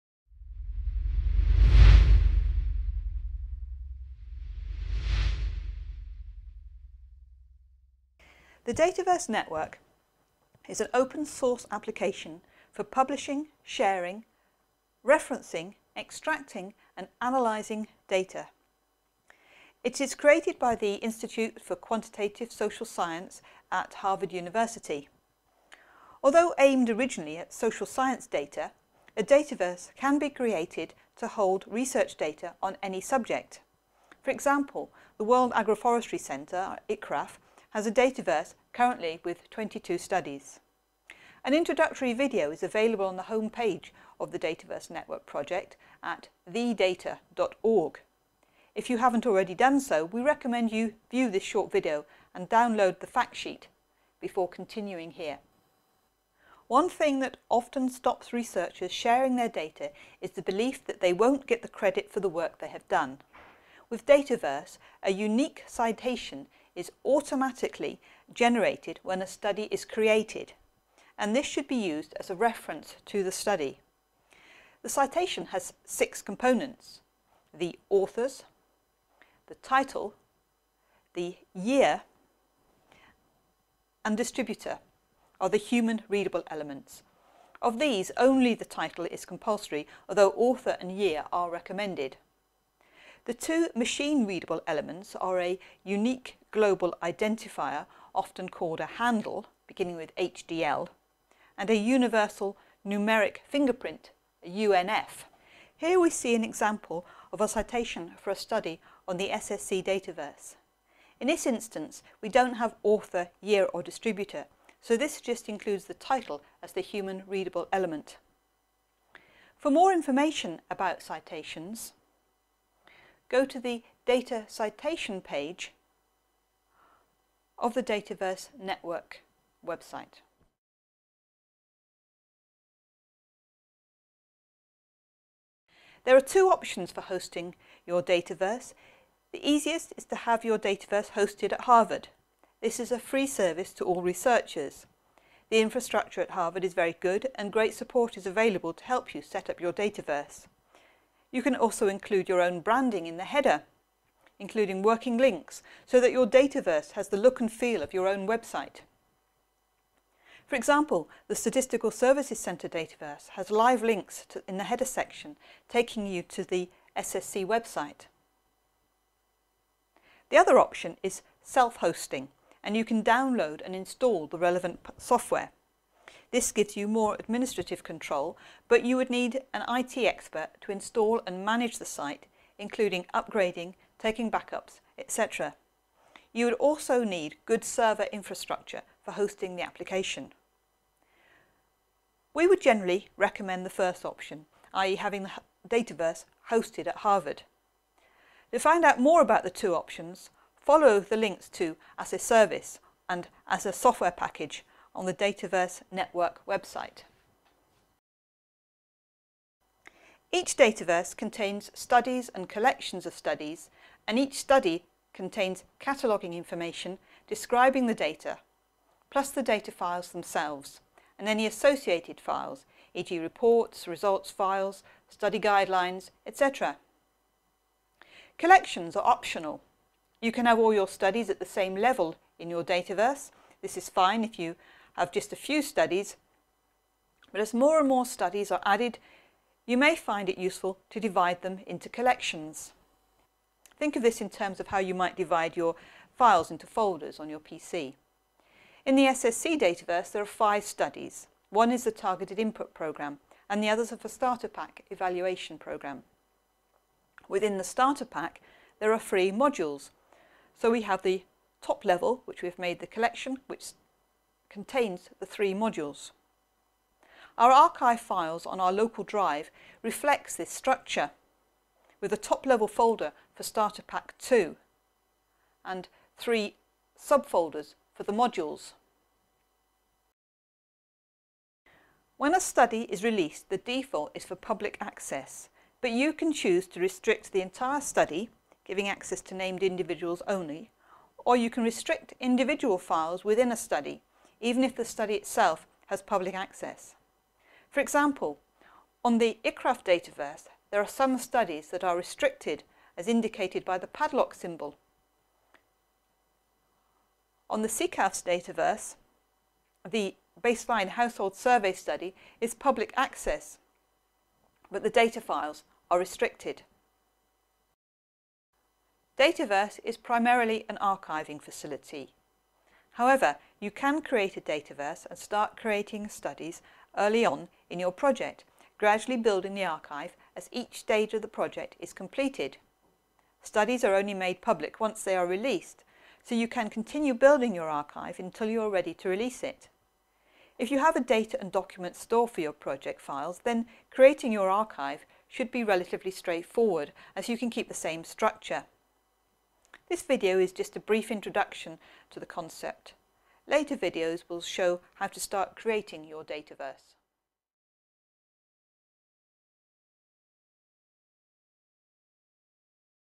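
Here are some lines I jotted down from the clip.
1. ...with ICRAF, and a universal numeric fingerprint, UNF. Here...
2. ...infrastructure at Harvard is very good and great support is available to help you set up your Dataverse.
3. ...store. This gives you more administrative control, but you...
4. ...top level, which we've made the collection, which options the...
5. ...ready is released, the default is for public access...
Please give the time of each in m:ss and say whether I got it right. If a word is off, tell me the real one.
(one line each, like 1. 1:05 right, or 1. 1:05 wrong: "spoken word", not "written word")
1. 1:39 wrong: "HDL", not "ICRAF"
2. 2:25 right
3. 2:54 wrong: "software", not "store"
4. 4:21 wrong: "contains", not "options"
5. 4:42 wrong: "study", not "ready".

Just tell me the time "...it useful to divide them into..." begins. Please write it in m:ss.
4:00.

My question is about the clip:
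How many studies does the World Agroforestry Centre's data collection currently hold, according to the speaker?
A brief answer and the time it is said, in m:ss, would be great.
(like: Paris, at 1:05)
22, at 0:39.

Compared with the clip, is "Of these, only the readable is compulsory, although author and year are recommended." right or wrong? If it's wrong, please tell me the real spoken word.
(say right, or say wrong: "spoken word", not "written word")
wrong: "title", not "readable".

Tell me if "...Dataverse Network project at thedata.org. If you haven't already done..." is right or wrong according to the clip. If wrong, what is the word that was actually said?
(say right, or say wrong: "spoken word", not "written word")
right.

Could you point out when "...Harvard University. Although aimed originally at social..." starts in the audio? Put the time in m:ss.
0:23.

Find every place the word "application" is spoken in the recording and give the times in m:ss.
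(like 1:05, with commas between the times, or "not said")
0:11, 3:09.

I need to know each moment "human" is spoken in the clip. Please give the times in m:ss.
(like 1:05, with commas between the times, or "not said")
1:25, 1:56.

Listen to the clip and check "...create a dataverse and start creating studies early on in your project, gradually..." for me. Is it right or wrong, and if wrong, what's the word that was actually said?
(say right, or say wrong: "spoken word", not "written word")
right.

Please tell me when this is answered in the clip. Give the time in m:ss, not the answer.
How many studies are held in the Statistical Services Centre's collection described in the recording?
4:10.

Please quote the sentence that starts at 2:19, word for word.
The easiest is to have your Dataverse hosted at Harvard.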